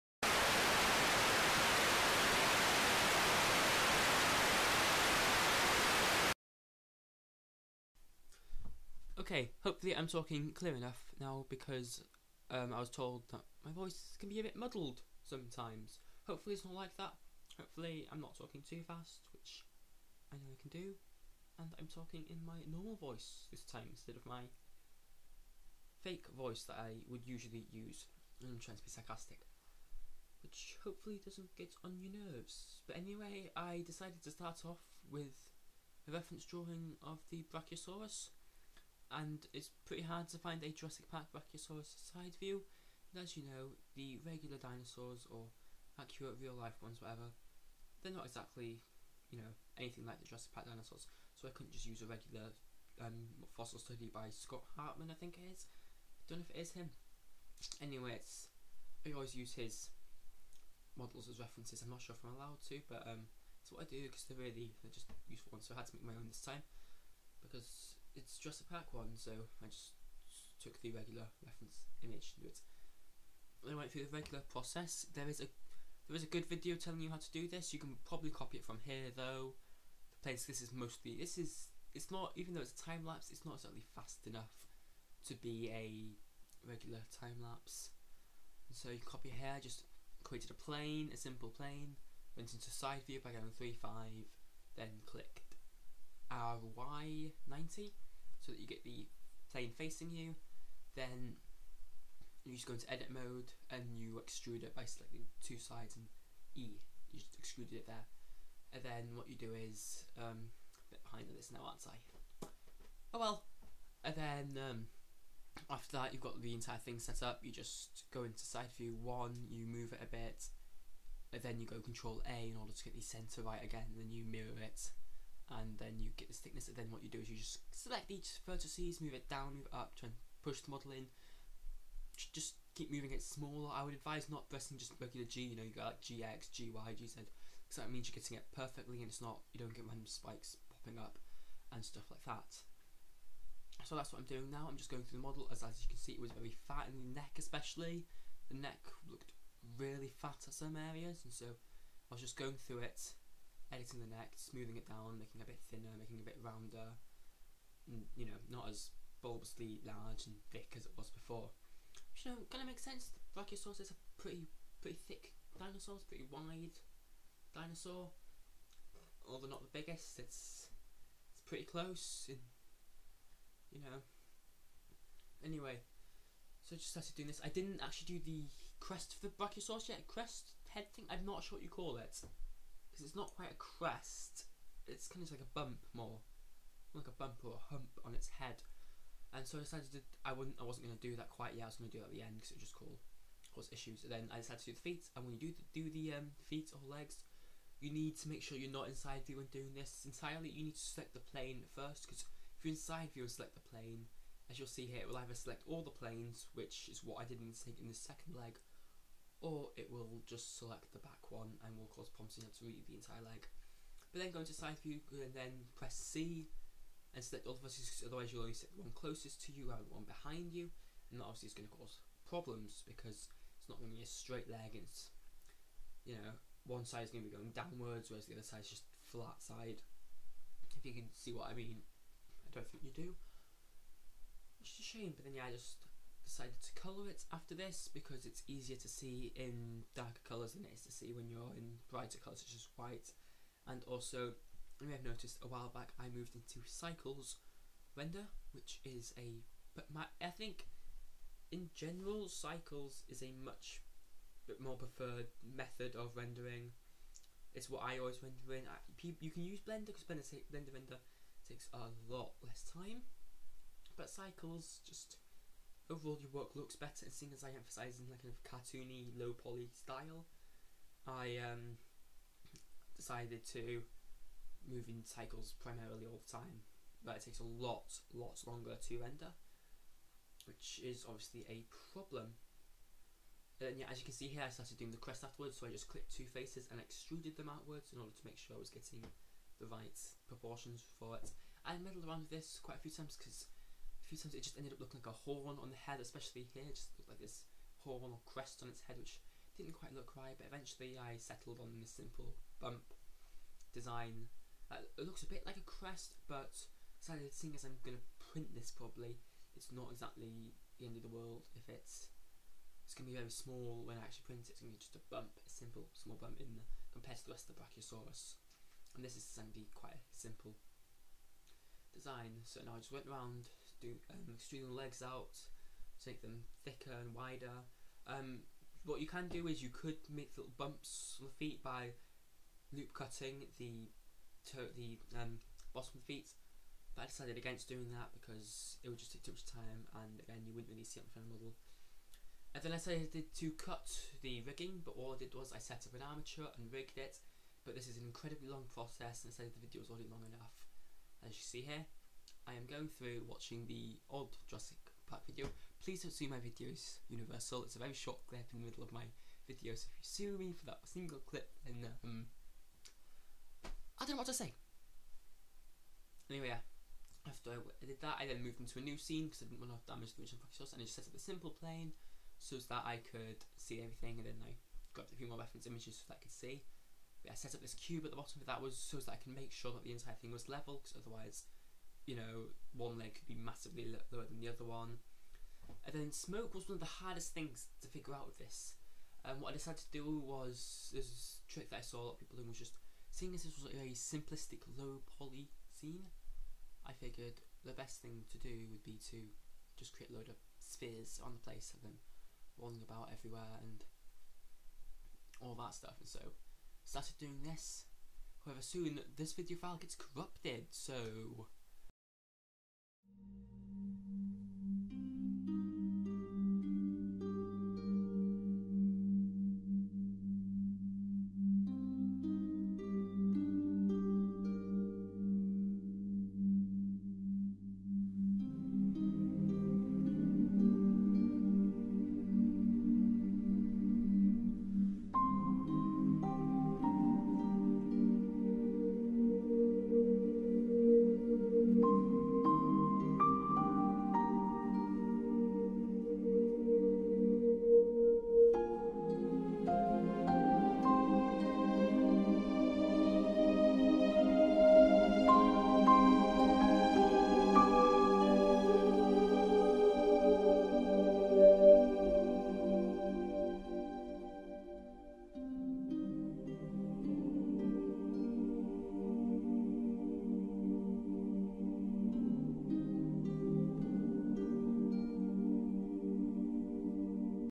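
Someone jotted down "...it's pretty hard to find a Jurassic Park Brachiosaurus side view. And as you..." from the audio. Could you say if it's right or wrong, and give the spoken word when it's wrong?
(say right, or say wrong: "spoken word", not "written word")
right.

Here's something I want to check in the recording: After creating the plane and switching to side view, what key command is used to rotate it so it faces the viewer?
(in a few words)
RY90.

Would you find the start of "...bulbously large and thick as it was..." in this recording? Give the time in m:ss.
2:39.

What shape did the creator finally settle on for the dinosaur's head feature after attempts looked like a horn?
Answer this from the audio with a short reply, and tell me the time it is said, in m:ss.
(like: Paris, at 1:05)
simple bump, at 5:01.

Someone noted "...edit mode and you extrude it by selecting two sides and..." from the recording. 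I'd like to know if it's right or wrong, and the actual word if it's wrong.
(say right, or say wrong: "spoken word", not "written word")
right.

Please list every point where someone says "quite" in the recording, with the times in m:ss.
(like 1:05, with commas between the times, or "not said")
3:03, 3:11, 4:52, 4:59, 5:19.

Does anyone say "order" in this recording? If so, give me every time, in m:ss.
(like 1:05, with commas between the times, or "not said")
2:02, 4:47.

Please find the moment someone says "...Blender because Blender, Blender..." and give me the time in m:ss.
4:19.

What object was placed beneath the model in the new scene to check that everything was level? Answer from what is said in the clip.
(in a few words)
cube.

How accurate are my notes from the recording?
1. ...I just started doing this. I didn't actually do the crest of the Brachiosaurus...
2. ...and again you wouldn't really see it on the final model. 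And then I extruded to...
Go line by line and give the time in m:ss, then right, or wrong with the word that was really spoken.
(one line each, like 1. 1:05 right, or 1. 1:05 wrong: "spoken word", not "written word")
1. 2:56 right
2. 5:39 wrong: "decided", not "extruded".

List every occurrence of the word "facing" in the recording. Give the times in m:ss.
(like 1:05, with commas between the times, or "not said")
1:39.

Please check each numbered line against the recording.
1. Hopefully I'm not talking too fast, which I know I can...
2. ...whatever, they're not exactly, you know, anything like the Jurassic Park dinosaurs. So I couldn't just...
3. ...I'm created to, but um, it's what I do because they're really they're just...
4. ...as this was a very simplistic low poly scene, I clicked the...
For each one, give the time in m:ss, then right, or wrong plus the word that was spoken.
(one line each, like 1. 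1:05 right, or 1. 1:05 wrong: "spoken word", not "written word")
1. 0:17 right
2. 0:47 right
3. 1:02 wrong: "allowed", not "created"
4. 6:33 wrong: "figured", not "clicked".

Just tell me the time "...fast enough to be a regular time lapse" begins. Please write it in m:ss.
1:23.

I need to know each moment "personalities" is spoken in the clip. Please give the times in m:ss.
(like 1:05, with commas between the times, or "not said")
not said.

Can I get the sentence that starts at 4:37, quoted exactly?
But it takes a lot, lot longer to render, which is obviously a problem.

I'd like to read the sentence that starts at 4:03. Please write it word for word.
And also, you may have noticed a while back I moved into Cycles Render, which is a...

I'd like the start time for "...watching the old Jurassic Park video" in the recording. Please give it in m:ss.
5:53.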